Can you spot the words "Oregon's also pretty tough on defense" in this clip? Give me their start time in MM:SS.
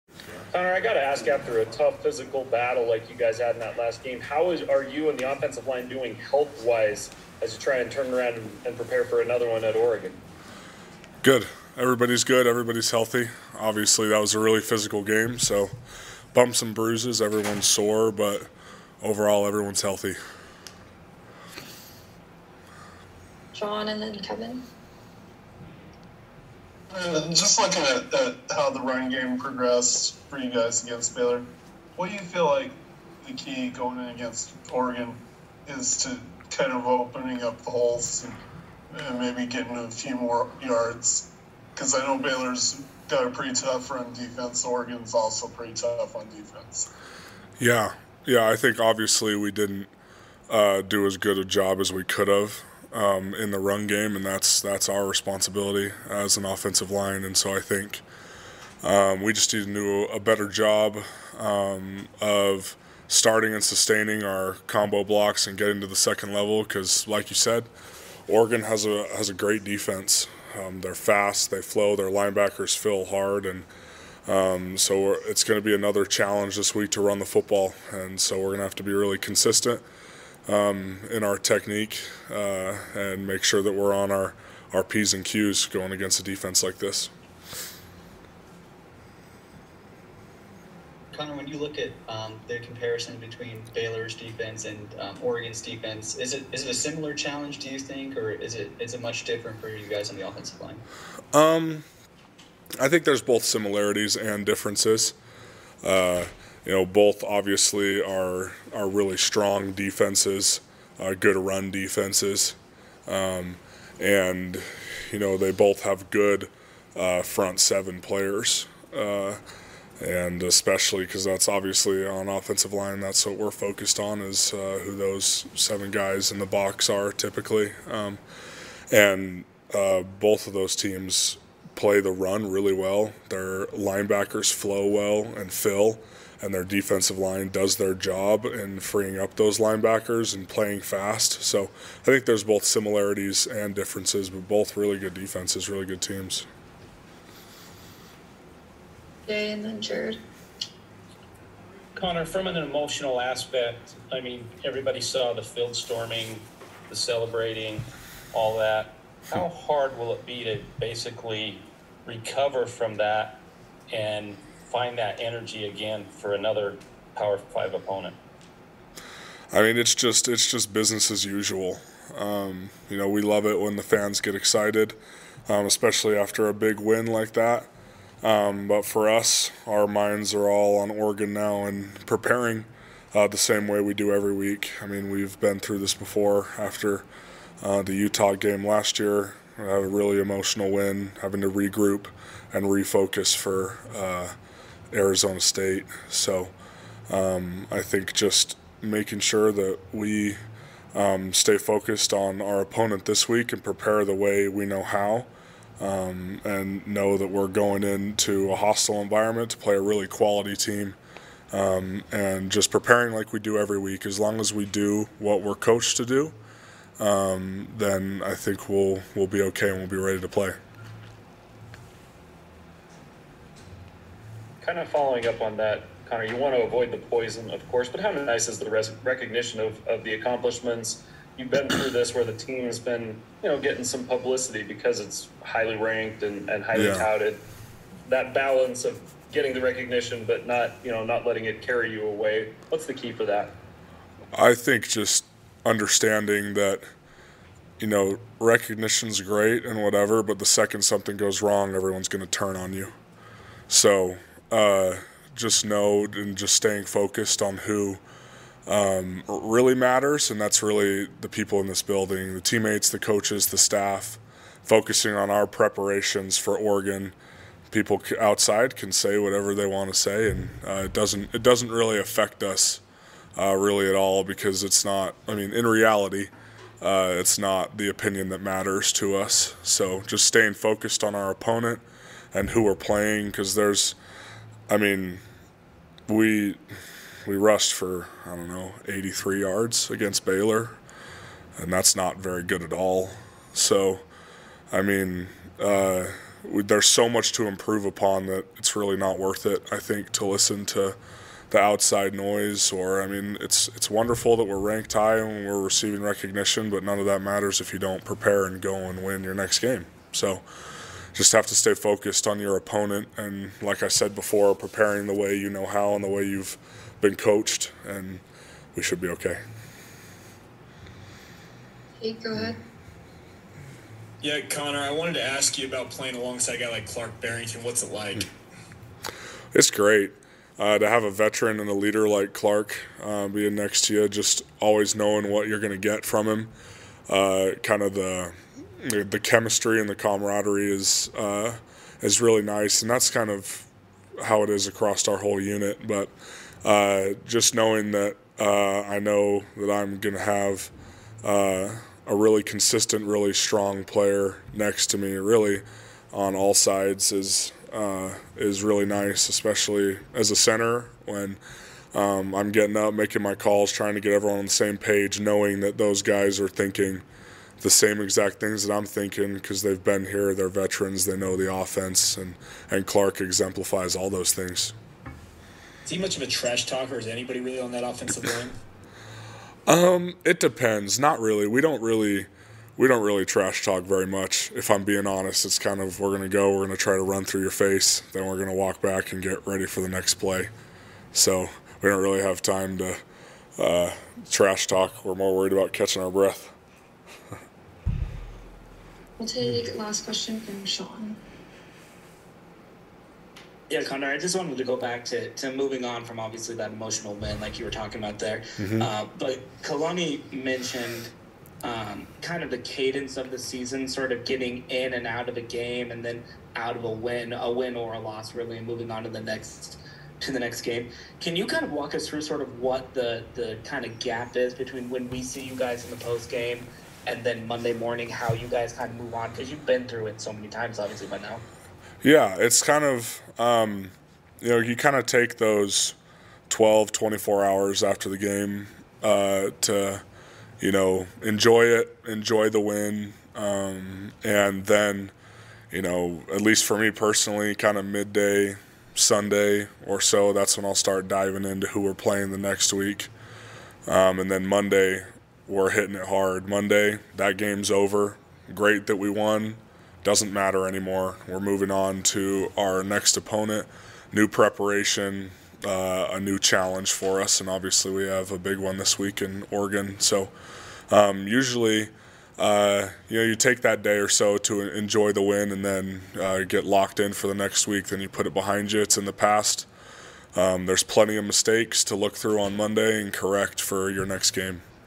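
00:44.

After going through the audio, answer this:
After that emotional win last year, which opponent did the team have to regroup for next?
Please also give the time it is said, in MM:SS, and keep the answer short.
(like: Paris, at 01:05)
Arizona State, at 03:14.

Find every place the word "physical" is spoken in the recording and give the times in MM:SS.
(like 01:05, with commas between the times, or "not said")
00:02, 00:14.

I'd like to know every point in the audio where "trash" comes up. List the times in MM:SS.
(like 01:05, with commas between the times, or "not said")
06:16, 06:23, 06:34.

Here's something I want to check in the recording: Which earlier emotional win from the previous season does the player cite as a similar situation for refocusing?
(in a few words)
Utah.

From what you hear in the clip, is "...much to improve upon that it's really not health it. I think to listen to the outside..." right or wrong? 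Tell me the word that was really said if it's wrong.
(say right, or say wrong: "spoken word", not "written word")
wrong: "worth", not "health".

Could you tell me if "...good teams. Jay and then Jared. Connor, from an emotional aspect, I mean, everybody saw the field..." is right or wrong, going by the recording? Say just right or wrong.
right.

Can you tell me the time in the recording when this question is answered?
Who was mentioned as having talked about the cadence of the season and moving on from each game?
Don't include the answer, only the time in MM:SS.
06:49.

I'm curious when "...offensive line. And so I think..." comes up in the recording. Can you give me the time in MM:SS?
00:56.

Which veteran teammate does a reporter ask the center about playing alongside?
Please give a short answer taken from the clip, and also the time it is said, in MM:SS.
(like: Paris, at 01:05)
Clark Barrington, at 05:26.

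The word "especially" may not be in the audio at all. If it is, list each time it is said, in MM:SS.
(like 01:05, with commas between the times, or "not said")
02:00, 02:55, 05:59.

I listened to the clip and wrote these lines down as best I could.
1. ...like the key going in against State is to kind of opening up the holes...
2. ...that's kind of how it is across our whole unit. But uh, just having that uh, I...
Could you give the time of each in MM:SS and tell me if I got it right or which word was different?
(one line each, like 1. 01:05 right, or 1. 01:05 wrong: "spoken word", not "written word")
1. 00:32 wrong: "Oregon", not "State"
2. 05:42 wrong: "knowing", not "having".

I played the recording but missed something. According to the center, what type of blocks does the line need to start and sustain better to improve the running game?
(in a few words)
Combo blocks.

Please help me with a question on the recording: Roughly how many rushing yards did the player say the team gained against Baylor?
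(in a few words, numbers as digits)
83.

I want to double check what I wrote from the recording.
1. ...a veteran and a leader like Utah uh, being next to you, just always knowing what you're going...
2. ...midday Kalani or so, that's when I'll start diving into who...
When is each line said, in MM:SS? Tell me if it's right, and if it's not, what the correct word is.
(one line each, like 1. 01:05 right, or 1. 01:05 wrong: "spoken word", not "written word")
1. 05:31 wrong: "Clark", not "Utah"
2. 07:27 wrong: "Sunday", not "Kalani".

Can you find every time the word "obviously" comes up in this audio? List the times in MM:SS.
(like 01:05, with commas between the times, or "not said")
00:13, 00:48, 01:47, 02:01, 06:46, 07:10, 07:47.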